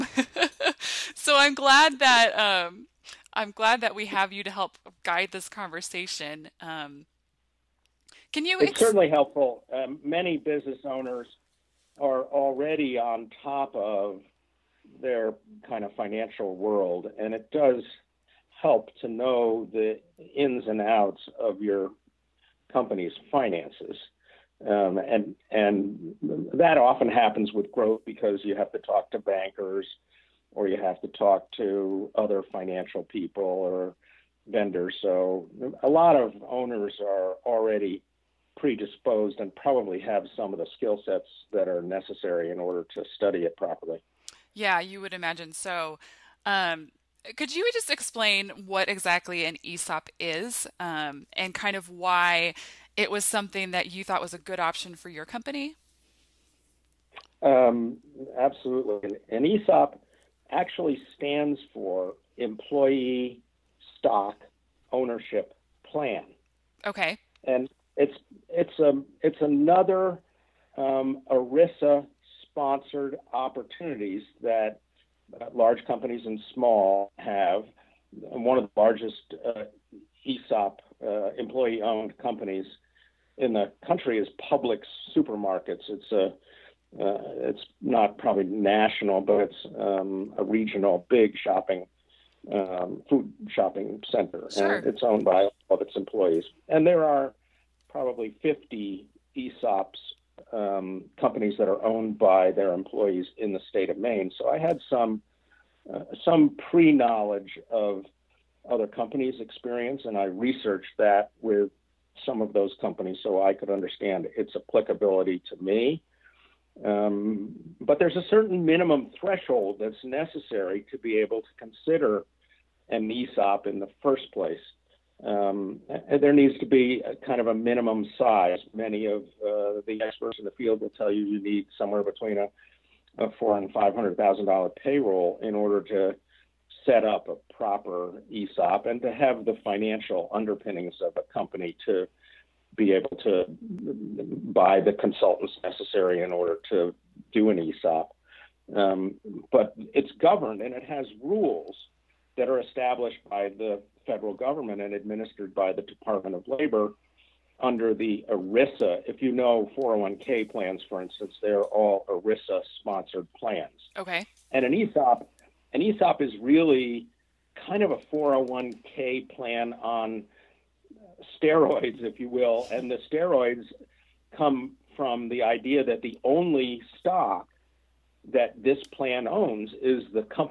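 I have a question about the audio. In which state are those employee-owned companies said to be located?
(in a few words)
Maine.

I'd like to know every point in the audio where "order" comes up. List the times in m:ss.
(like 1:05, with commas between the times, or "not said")
0:42, 2:15, 2:26.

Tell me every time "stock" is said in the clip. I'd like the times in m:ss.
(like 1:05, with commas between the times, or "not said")
1:03, 2:56.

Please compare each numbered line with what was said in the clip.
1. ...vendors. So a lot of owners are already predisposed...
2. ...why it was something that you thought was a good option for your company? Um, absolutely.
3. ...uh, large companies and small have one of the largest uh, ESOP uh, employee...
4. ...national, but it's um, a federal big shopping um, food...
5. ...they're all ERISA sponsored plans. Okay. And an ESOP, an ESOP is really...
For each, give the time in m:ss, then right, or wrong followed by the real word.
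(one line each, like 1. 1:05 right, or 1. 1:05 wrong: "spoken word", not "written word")
1. 0:34 right
2. 0:51 right
3. 1:15 right
4. 1:28 wrong: "regional", not "federal"
5. 2:41 right.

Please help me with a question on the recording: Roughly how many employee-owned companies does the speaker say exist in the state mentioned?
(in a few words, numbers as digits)
50.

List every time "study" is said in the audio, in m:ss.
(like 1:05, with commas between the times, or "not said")
0:43.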